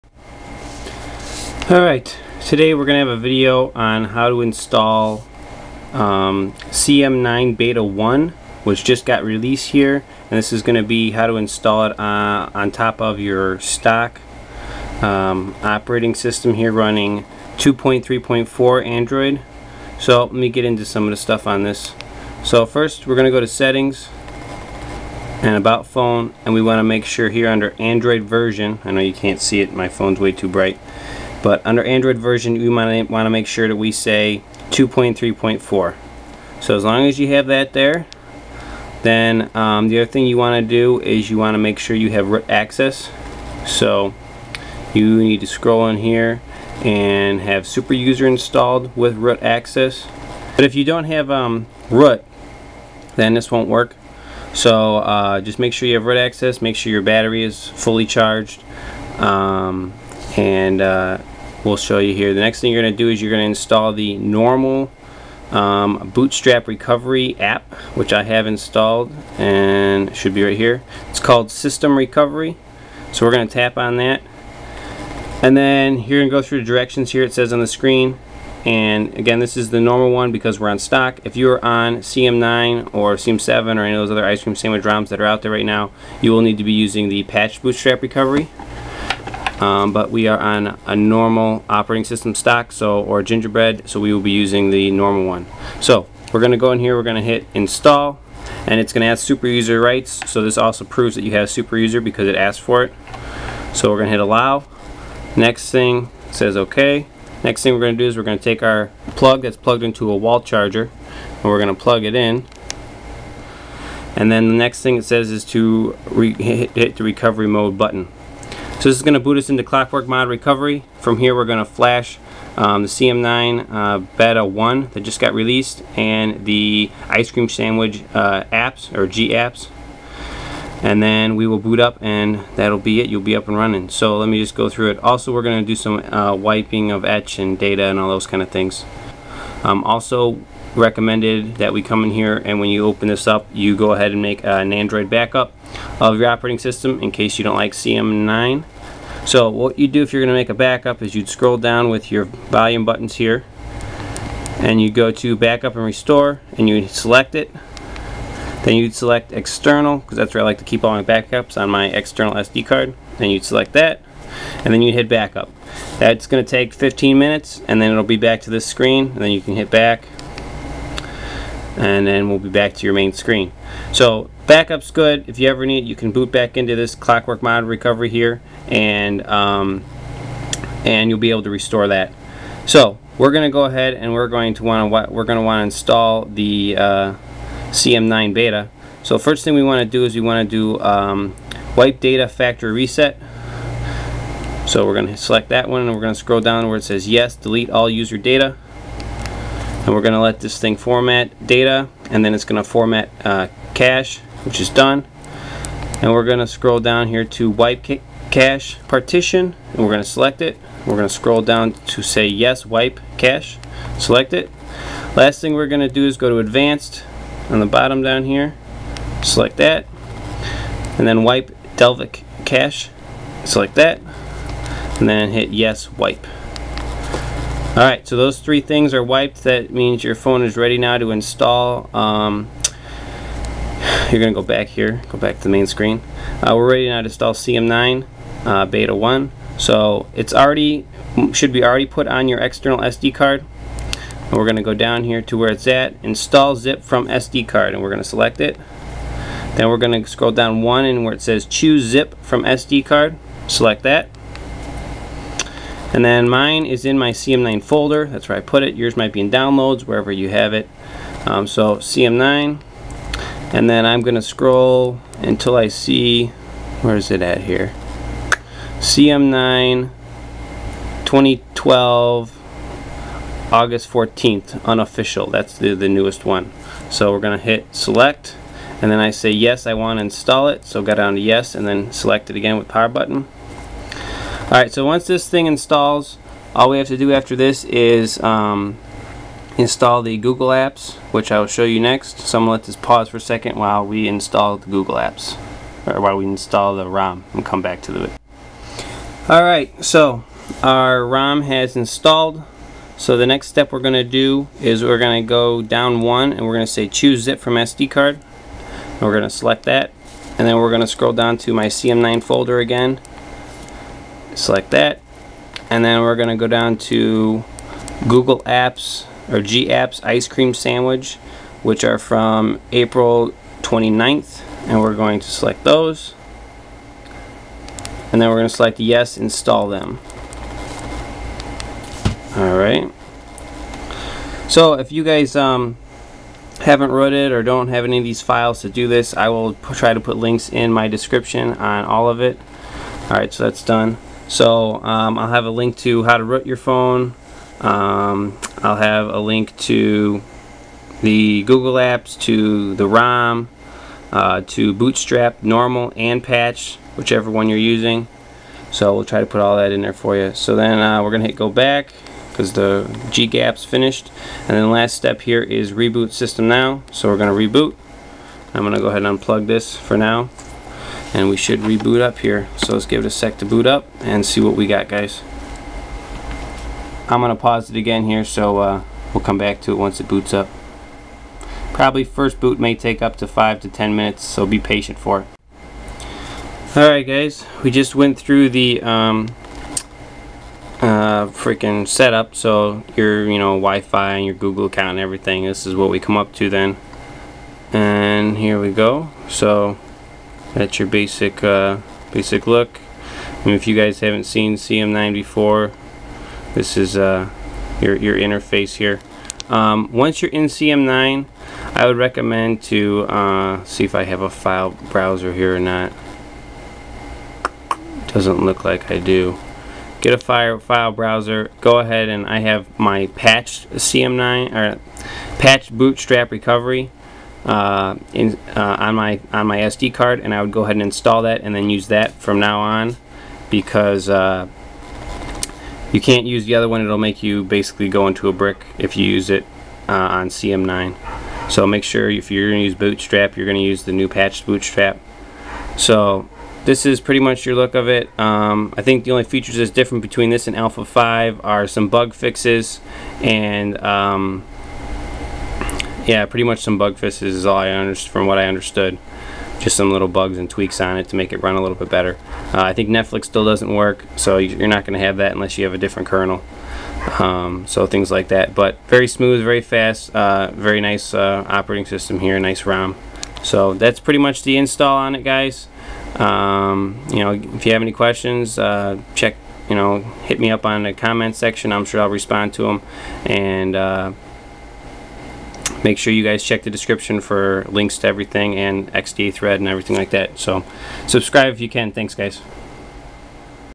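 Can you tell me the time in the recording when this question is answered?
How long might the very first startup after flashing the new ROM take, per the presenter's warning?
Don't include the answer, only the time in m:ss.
6:23.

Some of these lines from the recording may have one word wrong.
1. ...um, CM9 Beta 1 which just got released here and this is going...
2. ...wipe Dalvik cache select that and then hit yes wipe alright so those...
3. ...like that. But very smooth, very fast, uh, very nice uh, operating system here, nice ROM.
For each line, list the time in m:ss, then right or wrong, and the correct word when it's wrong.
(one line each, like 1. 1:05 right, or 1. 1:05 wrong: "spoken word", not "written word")
1. 0:05 right
2. 3:41 right
3. 7:48 right.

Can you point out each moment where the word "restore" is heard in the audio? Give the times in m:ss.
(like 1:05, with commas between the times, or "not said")
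2:35, 3:01.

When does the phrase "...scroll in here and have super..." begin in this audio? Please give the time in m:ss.
0:45.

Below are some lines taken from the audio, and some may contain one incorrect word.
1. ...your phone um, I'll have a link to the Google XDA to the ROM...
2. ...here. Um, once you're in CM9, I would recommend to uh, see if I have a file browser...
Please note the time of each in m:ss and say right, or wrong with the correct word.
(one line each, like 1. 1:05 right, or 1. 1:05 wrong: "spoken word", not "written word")
1. 5:46 wrong: "Apps", not "XDA"
2. 6:48 right.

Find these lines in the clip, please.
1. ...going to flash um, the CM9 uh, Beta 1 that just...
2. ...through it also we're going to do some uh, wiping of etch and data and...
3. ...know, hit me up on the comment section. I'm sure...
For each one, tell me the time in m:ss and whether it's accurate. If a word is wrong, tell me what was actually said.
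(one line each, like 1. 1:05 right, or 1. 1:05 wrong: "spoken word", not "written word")
1. 2:01 right
2. 2:14 right
3. 7:59 right.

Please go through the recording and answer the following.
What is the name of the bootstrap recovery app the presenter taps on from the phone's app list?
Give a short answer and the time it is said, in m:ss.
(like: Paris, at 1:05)
System Recovery, at 1:11.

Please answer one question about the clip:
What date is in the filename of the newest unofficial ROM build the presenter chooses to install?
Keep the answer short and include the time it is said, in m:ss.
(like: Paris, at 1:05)
August 14th, at 4:33.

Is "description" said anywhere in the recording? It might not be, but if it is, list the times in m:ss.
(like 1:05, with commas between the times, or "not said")
5:40, 8:06.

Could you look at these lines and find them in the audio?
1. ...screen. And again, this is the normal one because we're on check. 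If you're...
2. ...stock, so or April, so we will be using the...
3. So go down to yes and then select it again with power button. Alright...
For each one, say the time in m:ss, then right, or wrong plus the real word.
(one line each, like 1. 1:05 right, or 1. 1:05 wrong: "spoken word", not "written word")
1. 1:17 wrong: "stock", not "check"
2. 1:32 wrong: "Gingerbread", not "April"
3. 4:40 right.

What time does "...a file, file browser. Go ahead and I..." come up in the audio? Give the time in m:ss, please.
7:00.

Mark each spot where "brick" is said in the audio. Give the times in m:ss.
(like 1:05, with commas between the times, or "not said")
7:18.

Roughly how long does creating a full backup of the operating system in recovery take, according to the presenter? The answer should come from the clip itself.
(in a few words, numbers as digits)
15 minutes.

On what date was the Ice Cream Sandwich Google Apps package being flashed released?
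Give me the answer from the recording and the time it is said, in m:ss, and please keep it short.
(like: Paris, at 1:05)
April 29th, at 5:22.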